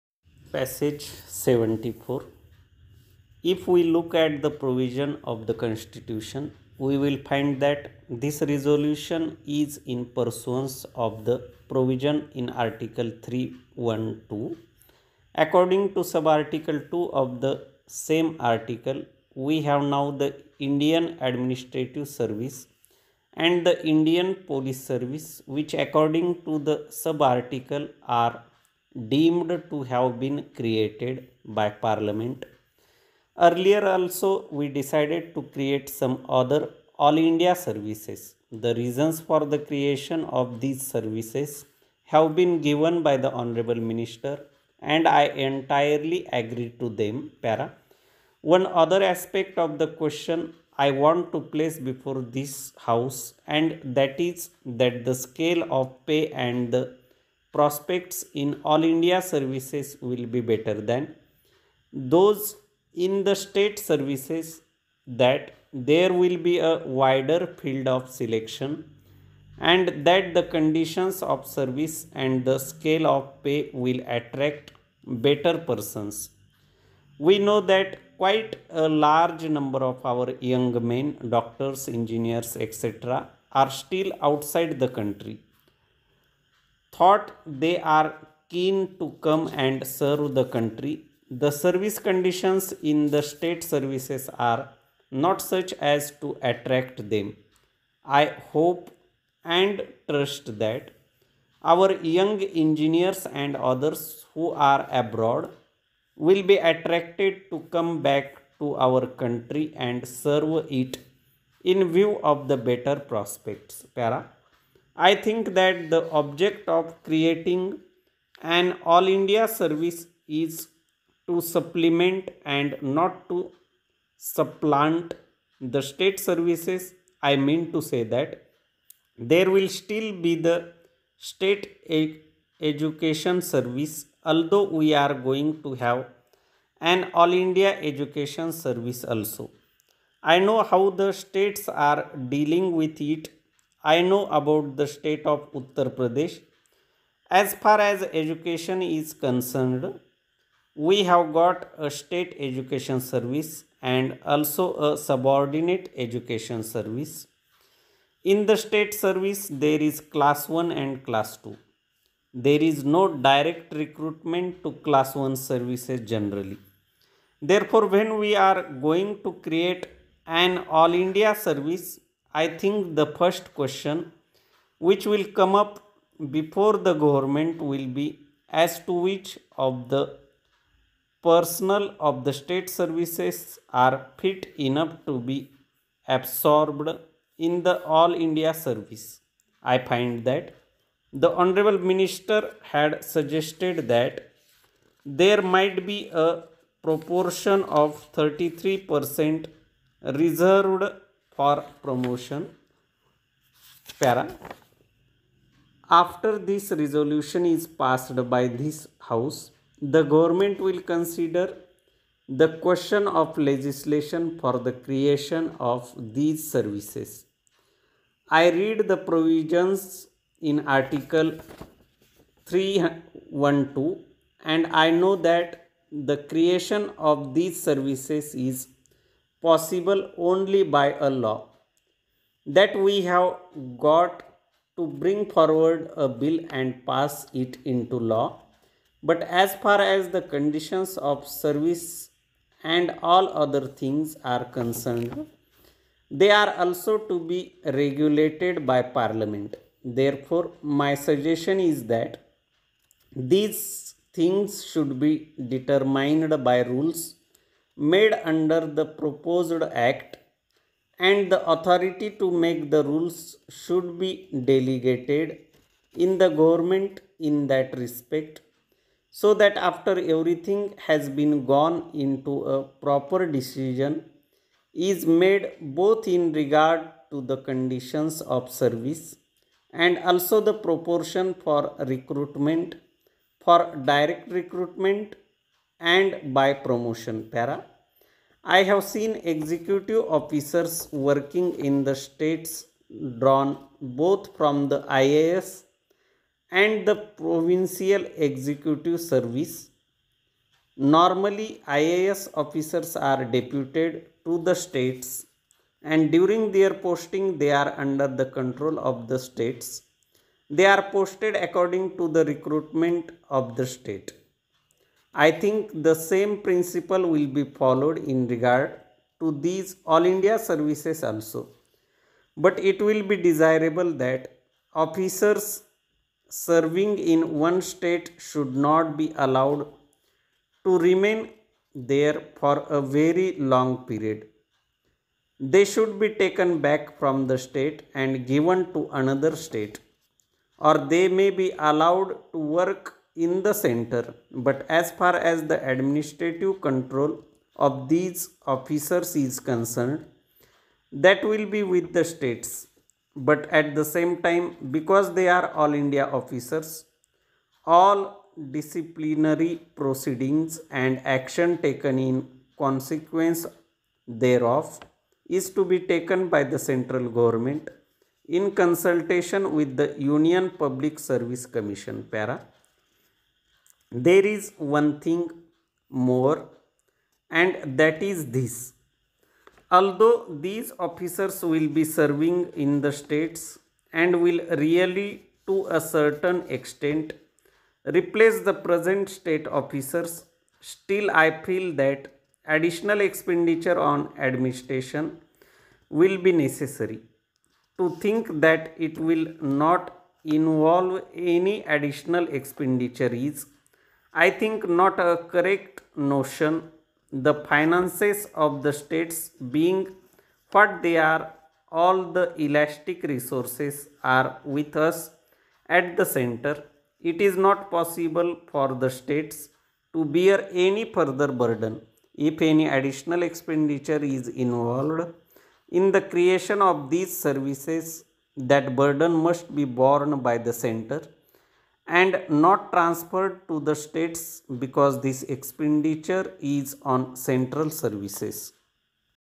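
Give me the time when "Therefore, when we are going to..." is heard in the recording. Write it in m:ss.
2:47.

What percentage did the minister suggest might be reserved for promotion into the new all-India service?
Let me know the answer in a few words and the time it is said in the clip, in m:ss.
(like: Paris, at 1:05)
33%, at 3:18.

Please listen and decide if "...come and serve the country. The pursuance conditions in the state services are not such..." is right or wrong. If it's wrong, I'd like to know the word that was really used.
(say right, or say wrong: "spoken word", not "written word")
wrong: "service", not "pursuance".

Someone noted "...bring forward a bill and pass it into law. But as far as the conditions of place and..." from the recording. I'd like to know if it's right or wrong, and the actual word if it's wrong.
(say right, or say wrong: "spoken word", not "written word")
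wrong: "service", not "place".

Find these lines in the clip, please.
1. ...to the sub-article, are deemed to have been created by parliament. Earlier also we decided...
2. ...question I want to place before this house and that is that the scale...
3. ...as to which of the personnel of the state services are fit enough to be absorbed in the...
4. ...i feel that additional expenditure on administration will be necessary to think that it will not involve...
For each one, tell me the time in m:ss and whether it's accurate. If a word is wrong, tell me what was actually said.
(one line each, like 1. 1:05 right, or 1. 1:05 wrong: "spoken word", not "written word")
1. 0:26 right
2. 0:49 right
3. 2:58 right
4. 6:31 right.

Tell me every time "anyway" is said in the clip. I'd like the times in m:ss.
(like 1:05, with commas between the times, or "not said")
not said.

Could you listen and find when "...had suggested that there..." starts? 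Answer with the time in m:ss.
3:12.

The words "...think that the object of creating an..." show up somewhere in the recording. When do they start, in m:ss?
1:55.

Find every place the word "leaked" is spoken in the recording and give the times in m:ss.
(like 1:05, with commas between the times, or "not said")
not said.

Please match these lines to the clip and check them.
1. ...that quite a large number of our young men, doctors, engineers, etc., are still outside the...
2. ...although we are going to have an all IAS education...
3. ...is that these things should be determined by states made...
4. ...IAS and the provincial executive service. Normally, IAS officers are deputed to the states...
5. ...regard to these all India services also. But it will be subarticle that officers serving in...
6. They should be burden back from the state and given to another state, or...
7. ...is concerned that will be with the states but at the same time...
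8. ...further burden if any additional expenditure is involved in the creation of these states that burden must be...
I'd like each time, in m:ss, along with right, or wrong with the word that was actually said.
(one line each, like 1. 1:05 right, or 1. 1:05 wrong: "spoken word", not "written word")
1. 1:17 right
2. 2:14 wrong: "India", not "IAS"
3. 4:11 wrong: "rules", not "states"
4. 4:54 right
5. 5:18 wrong: "desirable", not "subarticle"
6. 5:35 wrong: "taken", not "burden"
7. 5:49 right
8. 7:00 wrong: "services", not "states".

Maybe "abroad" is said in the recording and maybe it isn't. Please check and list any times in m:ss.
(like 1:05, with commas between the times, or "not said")
1:44.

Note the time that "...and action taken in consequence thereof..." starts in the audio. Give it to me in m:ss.
6:00.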